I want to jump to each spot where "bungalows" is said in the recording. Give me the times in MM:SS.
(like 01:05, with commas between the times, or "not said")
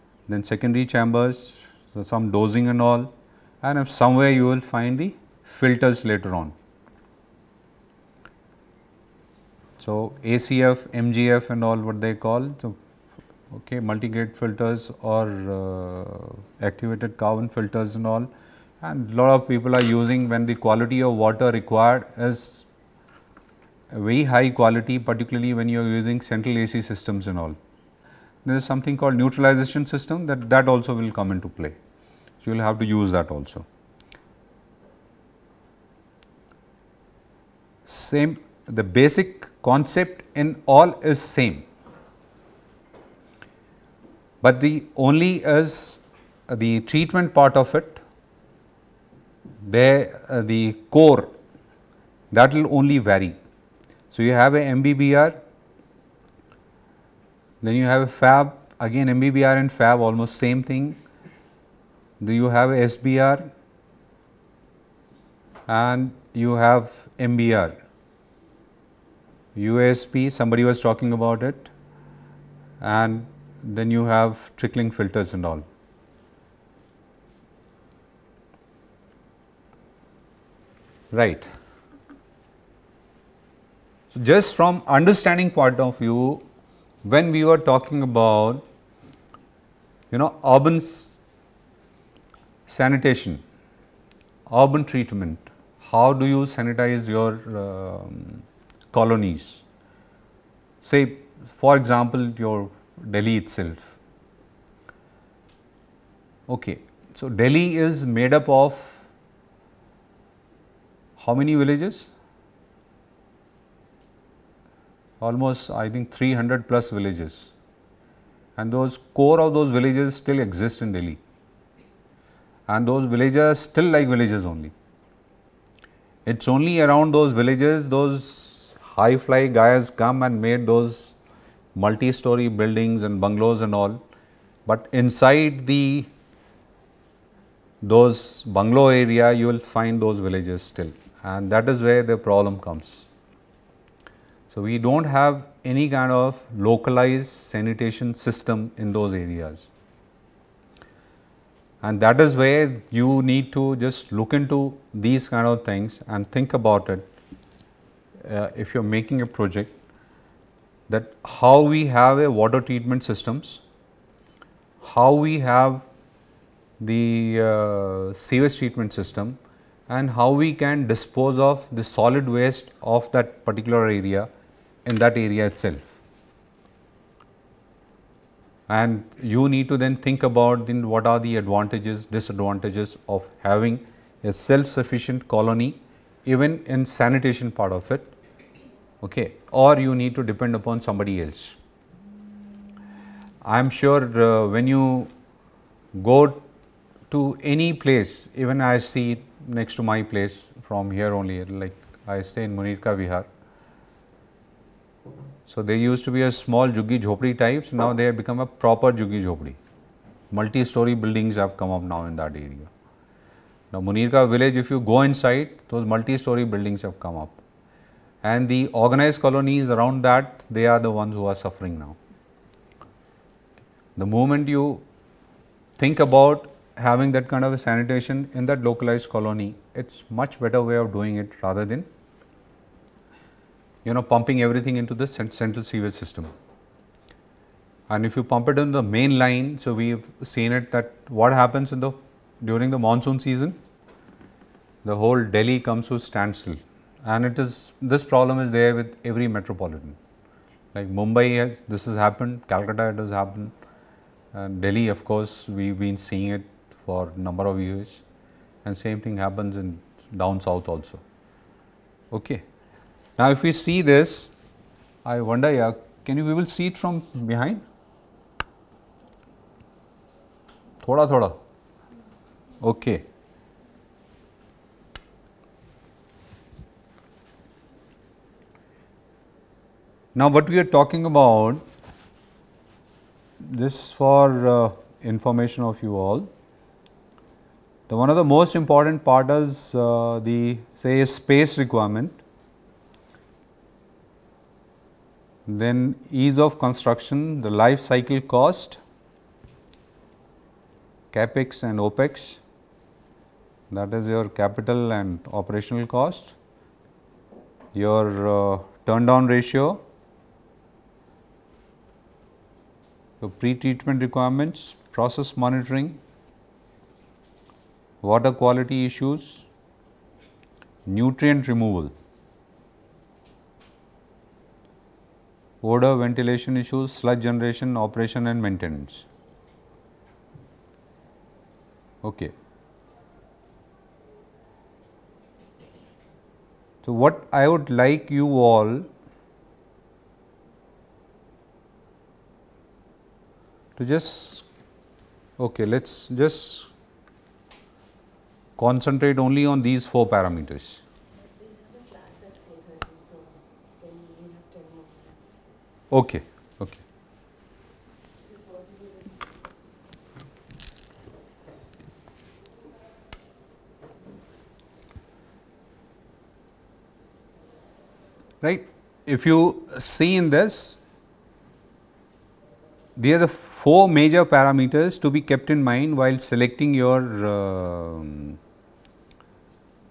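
02:13, 02:18.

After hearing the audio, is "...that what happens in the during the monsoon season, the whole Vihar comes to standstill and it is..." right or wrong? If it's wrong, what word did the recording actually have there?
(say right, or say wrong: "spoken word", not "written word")
wrong: "Delhi", not "Vihar".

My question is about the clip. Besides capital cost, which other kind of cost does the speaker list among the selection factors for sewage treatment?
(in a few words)
operational cost.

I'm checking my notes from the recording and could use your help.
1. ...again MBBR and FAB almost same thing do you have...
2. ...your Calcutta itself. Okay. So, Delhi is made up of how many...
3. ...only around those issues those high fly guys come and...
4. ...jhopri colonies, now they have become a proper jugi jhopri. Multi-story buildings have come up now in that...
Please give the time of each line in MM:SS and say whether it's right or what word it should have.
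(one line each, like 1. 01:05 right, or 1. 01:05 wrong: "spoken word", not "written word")
1. 00:58 right
2. 01:42 wrong: "Delhi", not "Calcutta"
3. 02:06 wrong: "villages", not "issues"
4. 03:26 wrong: "types", not "colonies".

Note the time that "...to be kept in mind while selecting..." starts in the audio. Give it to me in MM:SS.
06:15.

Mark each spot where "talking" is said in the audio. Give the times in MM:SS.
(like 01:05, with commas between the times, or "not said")
01:10, 01:27, 04:40.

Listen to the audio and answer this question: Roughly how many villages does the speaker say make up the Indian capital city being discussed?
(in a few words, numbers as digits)
300 plus.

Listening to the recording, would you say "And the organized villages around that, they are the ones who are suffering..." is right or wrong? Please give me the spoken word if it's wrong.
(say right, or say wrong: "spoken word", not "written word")
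wrong: "colonies", not "villages".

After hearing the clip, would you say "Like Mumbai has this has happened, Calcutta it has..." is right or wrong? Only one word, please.
right.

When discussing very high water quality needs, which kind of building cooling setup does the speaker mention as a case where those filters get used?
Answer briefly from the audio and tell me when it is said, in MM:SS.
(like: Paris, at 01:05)
central AC systems, at 00:26.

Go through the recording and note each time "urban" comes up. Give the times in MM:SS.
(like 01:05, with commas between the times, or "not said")
01:30, 01:34.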